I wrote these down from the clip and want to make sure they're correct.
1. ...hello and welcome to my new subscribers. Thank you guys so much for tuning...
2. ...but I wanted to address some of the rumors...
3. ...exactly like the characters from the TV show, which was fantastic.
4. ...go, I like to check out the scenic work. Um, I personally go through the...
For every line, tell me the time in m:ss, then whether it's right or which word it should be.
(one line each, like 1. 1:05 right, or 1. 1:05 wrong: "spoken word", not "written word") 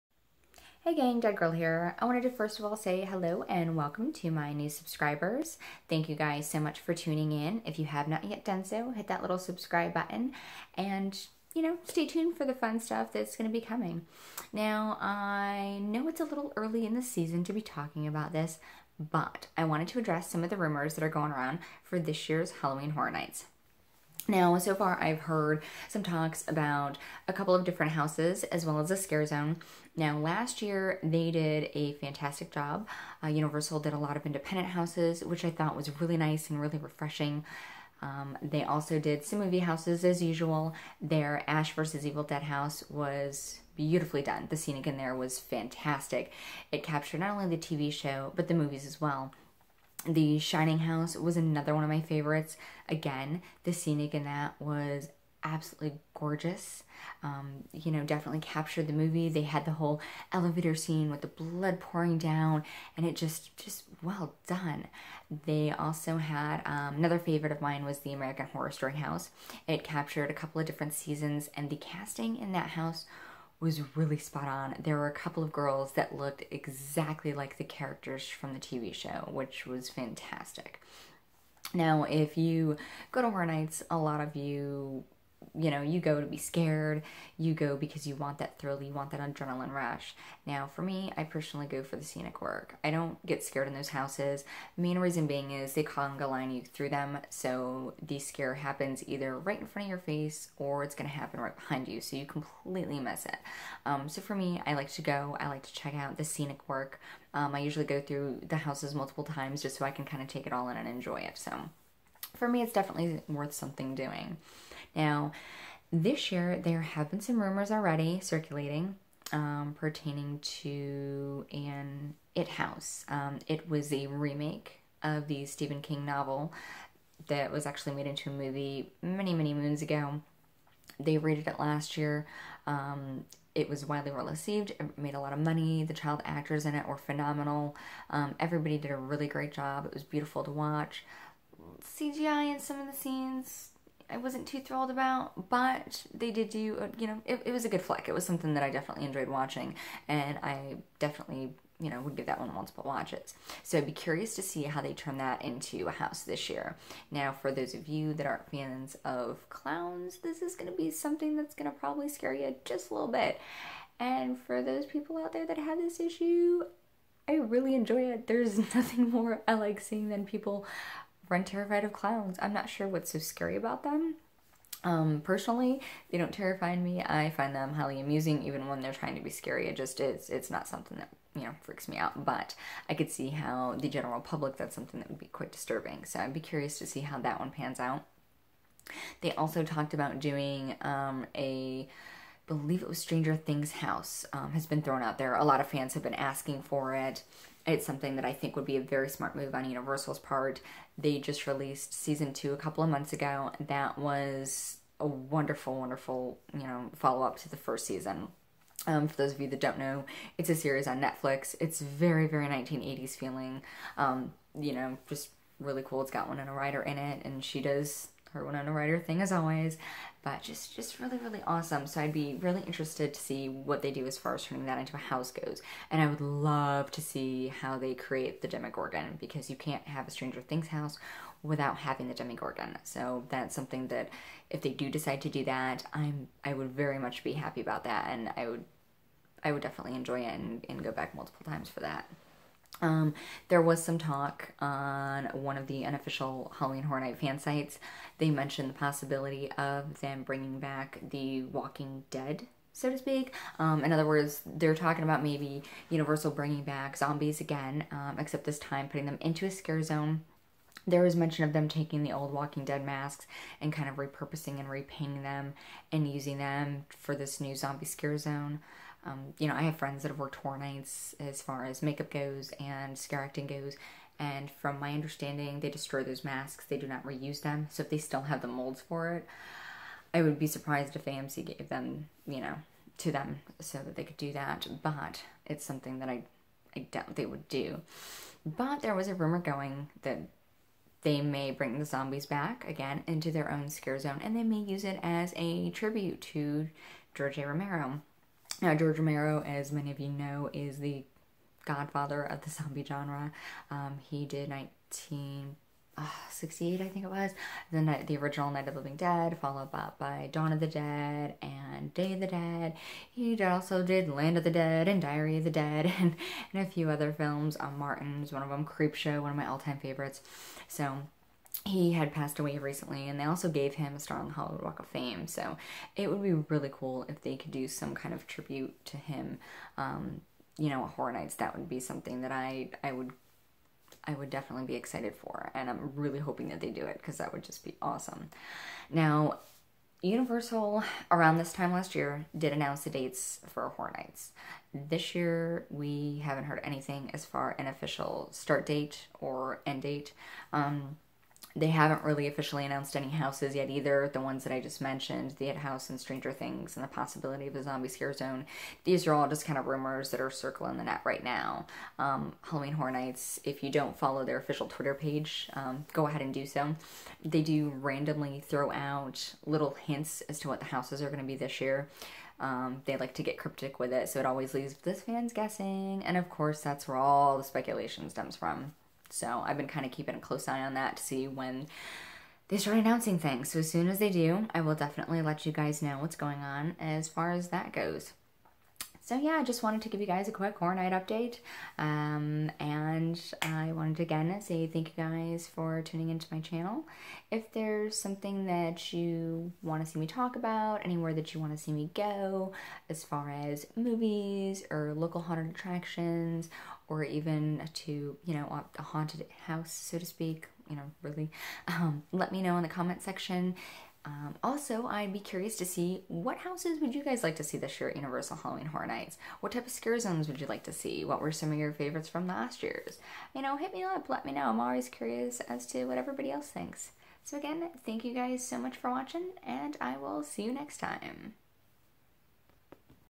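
1. 0:03 right
2. 0:18 right
3. 1:16 right
4. 1:45 wrong: "usually", not "personally".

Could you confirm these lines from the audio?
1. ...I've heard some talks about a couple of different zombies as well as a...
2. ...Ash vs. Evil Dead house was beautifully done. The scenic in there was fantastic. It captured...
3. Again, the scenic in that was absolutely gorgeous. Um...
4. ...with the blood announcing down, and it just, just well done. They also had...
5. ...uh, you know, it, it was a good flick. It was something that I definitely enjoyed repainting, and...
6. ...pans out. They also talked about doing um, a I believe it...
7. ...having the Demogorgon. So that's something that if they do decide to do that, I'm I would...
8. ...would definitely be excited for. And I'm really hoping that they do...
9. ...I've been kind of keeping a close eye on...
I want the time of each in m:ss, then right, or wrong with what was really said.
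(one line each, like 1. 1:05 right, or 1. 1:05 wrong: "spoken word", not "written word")
1. 0:25 wrong: "houses", not "zombies"
2. 0:41 right
3. 0:52 right
4. 1:01 wrong: "pouring", not "announcing"
5. 2:26 wrong: "watching", not "repainting"
6. 3:07 right
7. 3:51 right
8. 5:34 right
9. 6:19 right.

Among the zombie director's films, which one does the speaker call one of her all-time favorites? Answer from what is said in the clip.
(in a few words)
Creepshow.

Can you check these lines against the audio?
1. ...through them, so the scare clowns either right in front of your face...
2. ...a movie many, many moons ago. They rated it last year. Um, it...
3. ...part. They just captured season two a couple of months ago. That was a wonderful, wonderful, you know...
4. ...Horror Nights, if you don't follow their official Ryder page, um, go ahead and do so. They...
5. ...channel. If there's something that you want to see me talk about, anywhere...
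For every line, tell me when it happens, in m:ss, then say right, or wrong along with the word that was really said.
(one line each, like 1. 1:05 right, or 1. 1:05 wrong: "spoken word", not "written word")
1. 1:36 wrong: "happens", not "clowns"
2. 2:08 right
3. 3:20 wrong: "released", not "captured"
4. 6:02 wrong: "Twitter", not "Ryder"
5. 6:36 right.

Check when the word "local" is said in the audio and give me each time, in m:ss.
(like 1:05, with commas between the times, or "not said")
6:44.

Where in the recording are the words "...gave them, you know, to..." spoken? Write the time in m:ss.
4:41.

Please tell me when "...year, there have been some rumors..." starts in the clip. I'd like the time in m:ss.
1:56.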